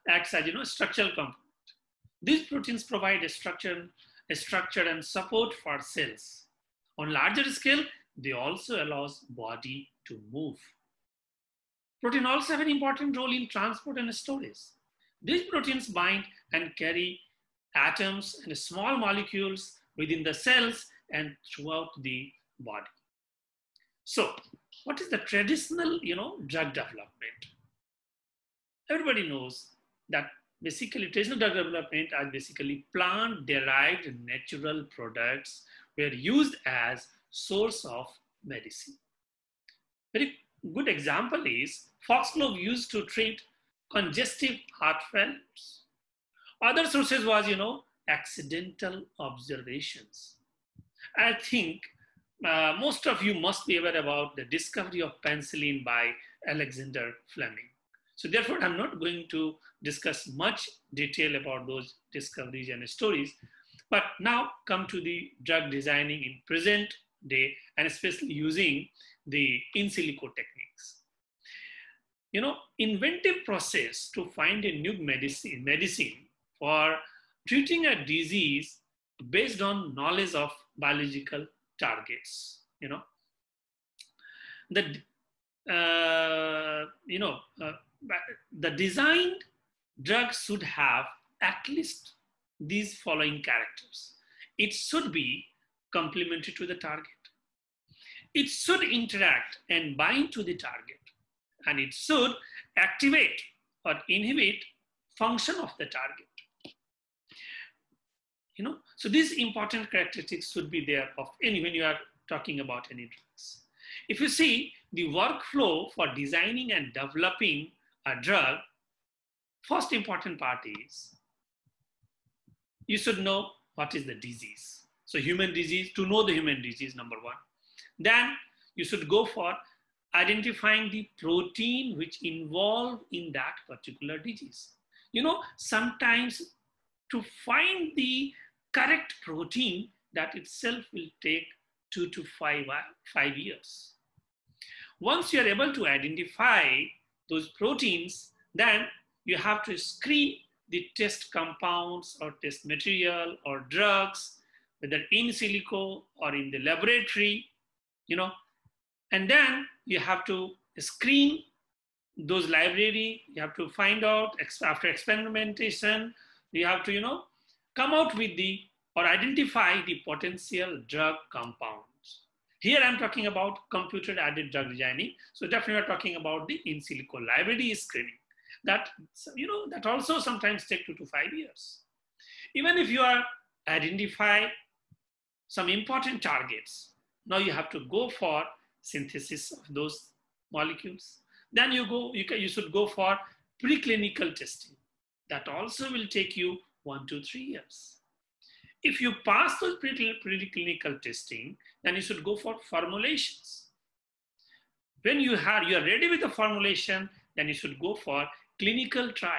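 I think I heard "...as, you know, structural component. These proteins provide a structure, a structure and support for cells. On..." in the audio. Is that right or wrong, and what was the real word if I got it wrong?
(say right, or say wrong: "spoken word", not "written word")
right.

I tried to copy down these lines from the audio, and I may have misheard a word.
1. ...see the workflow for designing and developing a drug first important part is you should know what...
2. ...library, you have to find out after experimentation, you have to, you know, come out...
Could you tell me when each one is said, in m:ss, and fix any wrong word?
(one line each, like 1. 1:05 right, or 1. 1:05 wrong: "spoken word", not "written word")
1. 1:54 right
2. 2:42 right.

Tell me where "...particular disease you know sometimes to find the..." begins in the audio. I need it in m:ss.
2:13.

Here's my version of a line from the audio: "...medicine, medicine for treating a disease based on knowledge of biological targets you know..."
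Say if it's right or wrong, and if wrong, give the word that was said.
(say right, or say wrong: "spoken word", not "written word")
right.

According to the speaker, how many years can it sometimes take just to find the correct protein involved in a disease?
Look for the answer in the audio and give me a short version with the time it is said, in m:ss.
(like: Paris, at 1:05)
2 to 5 years, at 2:21.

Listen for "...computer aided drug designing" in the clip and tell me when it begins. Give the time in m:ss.
2:53.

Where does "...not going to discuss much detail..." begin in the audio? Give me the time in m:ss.
0:58.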